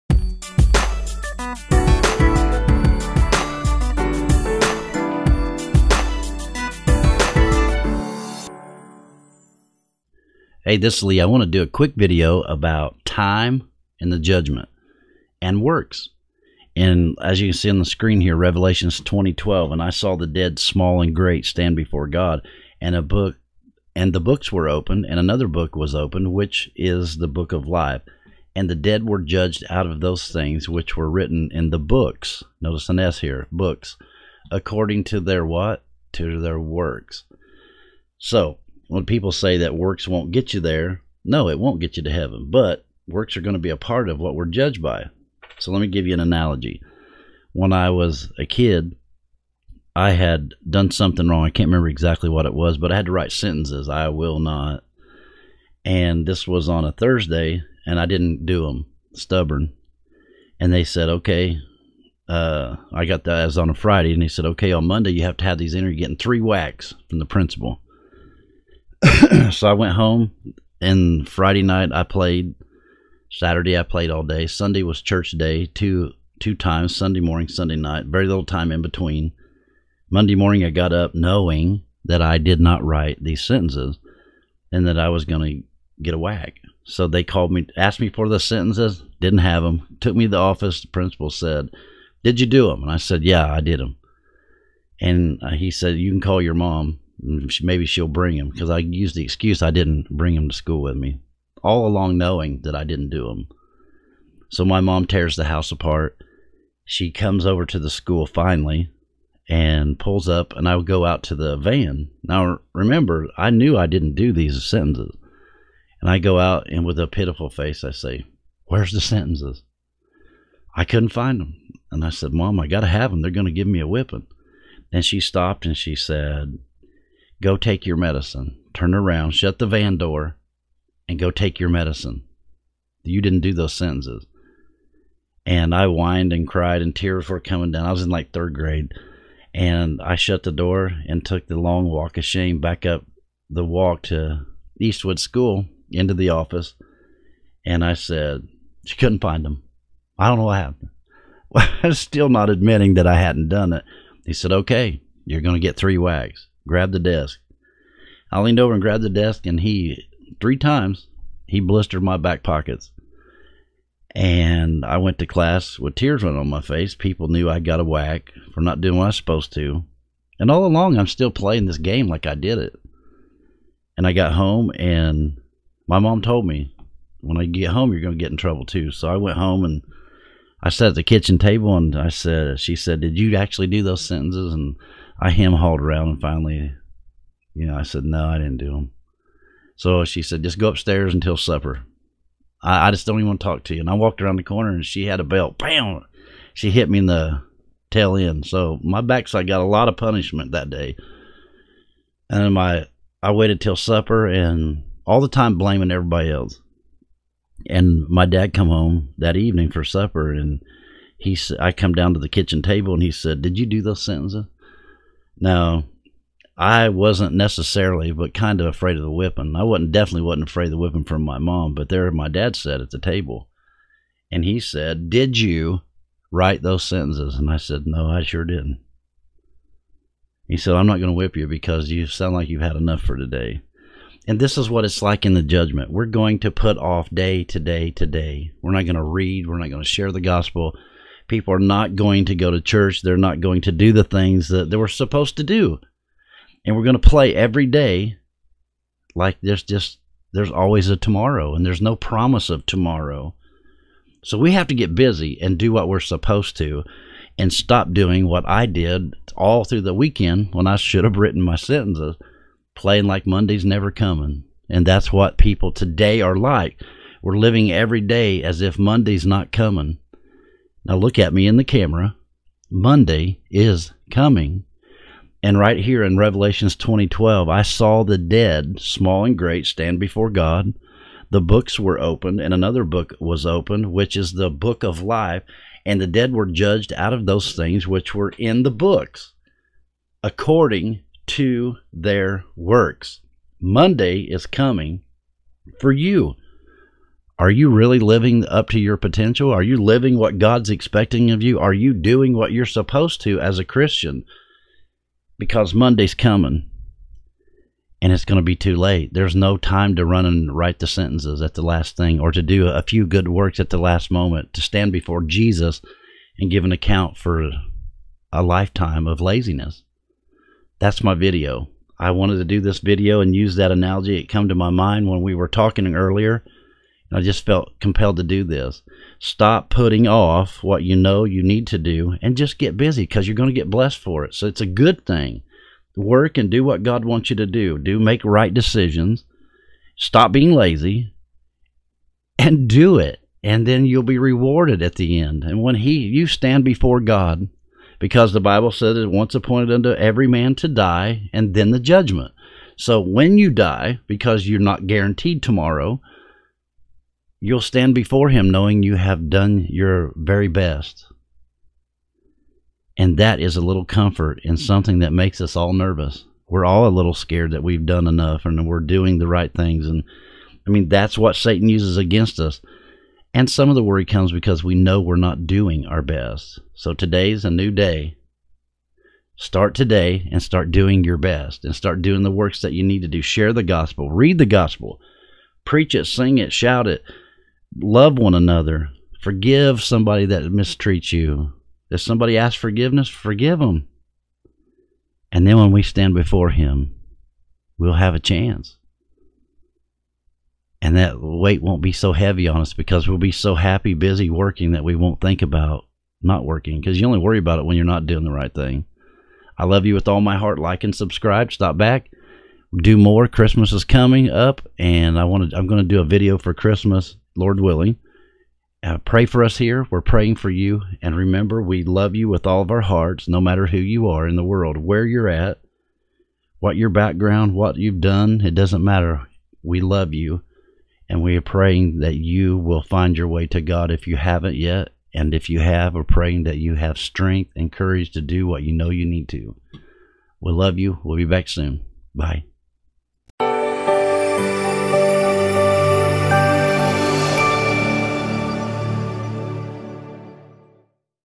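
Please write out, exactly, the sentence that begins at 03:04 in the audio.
And I hem hauled around and finally, you know, I said, no, I didn't do them.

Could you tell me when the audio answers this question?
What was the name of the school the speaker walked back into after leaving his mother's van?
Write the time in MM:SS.
02:24.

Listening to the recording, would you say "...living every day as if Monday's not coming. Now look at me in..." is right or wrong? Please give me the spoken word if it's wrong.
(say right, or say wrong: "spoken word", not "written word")
right.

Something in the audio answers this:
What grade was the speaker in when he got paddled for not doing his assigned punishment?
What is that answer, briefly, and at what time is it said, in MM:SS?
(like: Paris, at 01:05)
Third grade, at 02:18.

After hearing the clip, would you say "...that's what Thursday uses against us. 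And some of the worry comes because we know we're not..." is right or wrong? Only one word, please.
wrong.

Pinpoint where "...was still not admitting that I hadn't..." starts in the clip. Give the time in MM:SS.
02:31.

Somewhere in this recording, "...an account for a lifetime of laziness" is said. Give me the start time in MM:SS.
05:16.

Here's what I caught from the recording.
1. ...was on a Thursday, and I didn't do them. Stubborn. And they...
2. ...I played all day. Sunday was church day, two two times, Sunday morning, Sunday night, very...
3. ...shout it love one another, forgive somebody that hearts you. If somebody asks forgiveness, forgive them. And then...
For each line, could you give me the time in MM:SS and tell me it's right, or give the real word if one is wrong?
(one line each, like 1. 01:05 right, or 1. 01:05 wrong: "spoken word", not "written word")
1. 00:56 right
2. 01:13 right
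3. 06:26 wrong: "mistreats", not "hearts".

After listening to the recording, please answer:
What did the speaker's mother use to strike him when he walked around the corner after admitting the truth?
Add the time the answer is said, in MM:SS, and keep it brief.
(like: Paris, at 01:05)
A belt, at 03:15.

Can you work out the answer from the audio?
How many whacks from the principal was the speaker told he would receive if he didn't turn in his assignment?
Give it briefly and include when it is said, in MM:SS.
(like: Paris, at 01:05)
3, at 01:06.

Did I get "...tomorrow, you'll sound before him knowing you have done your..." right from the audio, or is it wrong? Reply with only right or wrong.
wrong.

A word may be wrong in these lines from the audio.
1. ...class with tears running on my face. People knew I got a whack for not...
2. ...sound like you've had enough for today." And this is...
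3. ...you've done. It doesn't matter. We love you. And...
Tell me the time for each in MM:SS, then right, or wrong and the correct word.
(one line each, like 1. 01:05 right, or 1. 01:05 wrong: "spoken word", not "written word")
1. 02:45 right
2. 03:52 right
3. 07:07 right.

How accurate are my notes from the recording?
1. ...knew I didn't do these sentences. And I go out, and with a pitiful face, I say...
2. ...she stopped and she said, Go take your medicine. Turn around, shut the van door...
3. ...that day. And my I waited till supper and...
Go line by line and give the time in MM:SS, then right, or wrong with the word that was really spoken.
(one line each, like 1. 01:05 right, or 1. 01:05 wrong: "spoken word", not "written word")
1. 01:53 right
2. 02:05 right
3. 03:20 right.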